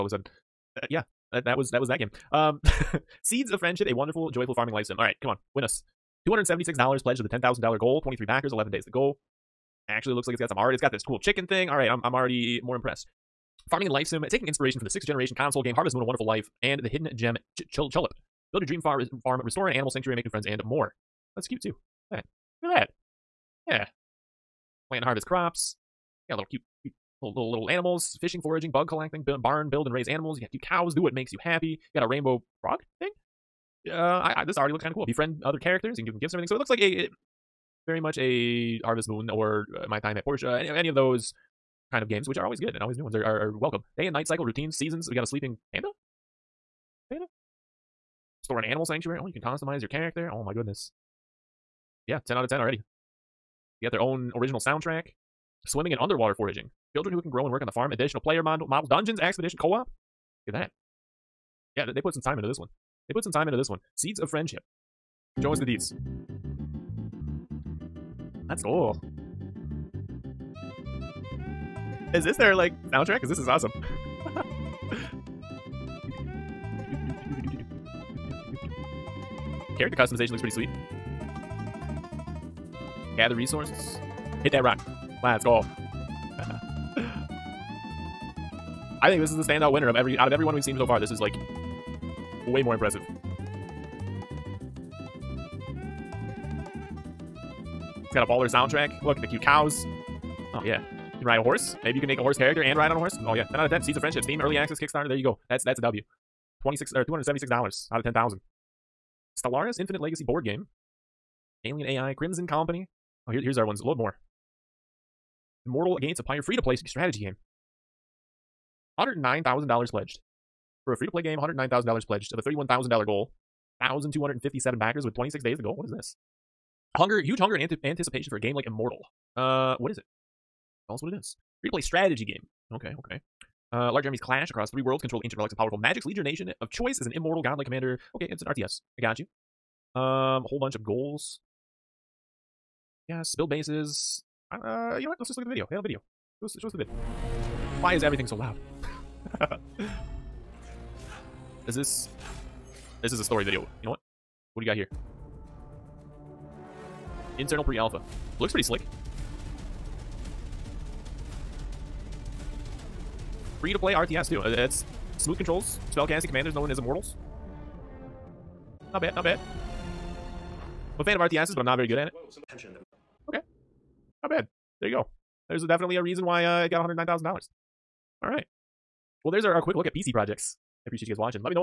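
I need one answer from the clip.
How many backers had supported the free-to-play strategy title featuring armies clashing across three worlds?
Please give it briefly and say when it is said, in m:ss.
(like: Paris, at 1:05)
1,257, at 2:03.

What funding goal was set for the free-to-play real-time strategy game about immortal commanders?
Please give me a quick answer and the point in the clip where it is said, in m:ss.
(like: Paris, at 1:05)
$31,000, at 2:02.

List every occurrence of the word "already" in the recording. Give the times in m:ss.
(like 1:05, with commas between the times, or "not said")
0:12, 0:34, 0:52.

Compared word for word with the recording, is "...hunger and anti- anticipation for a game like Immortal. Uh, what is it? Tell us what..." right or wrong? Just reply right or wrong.
right.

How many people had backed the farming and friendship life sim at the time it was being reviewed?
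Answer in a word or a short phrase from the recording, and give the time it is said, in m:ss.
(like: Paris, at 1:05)
23, at 0:08.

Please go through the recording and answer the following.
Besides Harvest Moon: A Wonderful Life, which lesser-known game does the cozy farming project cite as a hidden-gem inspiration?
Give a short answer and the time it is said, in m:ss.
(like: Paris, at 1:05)
Chulip, at 0:17.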